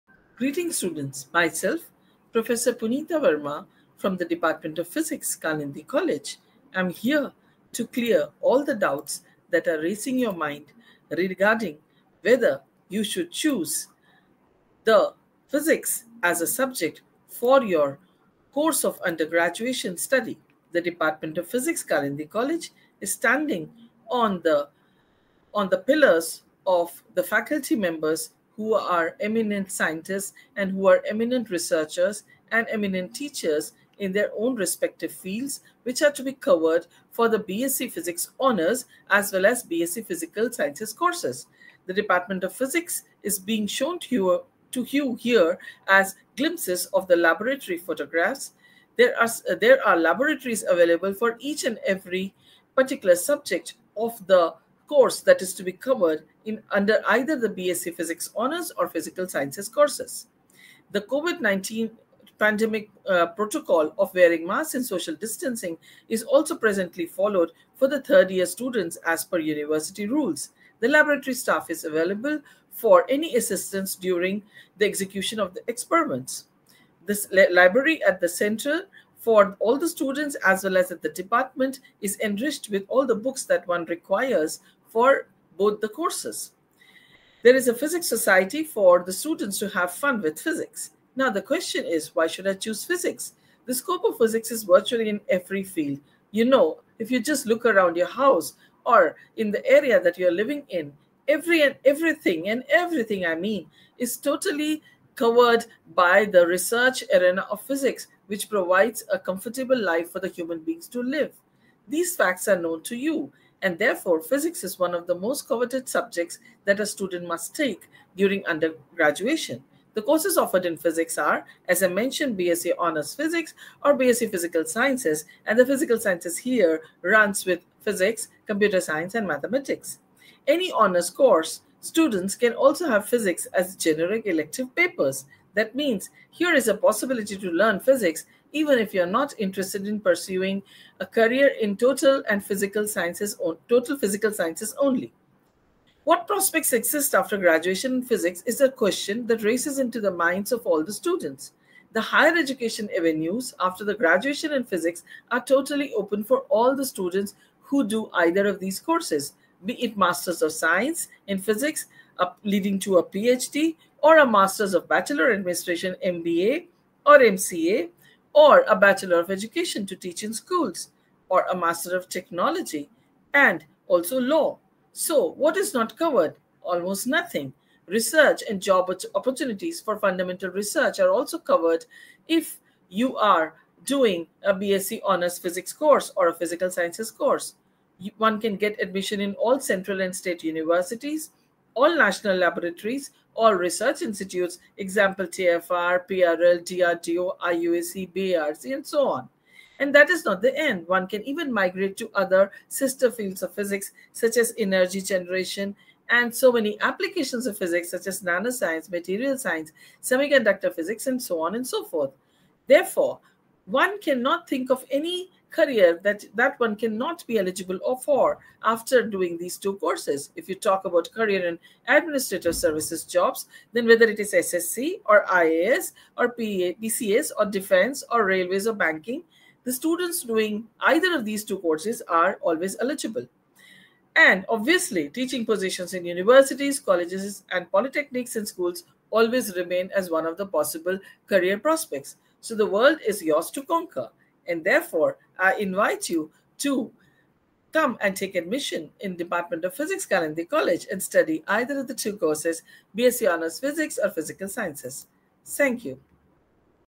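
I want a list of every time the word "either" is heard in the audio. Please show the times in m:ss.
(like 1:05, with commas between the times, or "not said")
0:57, 2:38, 3:50, 4:11.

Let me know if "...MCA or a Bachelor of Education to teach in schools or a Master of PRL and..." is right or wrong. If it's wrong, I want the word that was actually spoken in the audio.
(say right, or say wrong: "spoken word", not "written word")
wrong: "Technology", not "PRL".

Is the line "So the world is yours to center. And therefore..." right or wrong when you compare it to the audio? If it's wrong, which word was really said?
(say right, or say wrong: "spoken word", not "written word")
wrong: "conquer", not "center".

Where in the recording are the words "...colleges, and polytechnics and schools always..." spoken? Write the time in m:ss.
3:56.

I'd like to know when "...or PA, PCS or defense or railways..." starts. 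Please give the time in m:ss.
3:46.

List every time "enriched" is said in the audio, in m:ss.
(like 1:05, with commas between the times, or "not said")
1:22.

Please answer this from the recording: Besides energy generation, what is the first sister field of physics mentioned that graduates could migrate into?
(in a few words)
Nanoscience.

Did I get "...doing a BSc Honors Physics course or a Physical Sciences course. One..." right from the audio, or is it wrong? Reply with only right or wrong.
right.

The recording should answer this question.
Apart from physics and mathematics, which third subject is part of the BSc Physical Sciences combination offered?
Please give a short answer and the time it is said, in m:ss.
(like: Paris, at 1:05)
Computer science, at 2:08.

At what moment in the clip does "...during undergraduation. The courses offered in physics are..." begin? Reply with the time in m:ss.
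1:58.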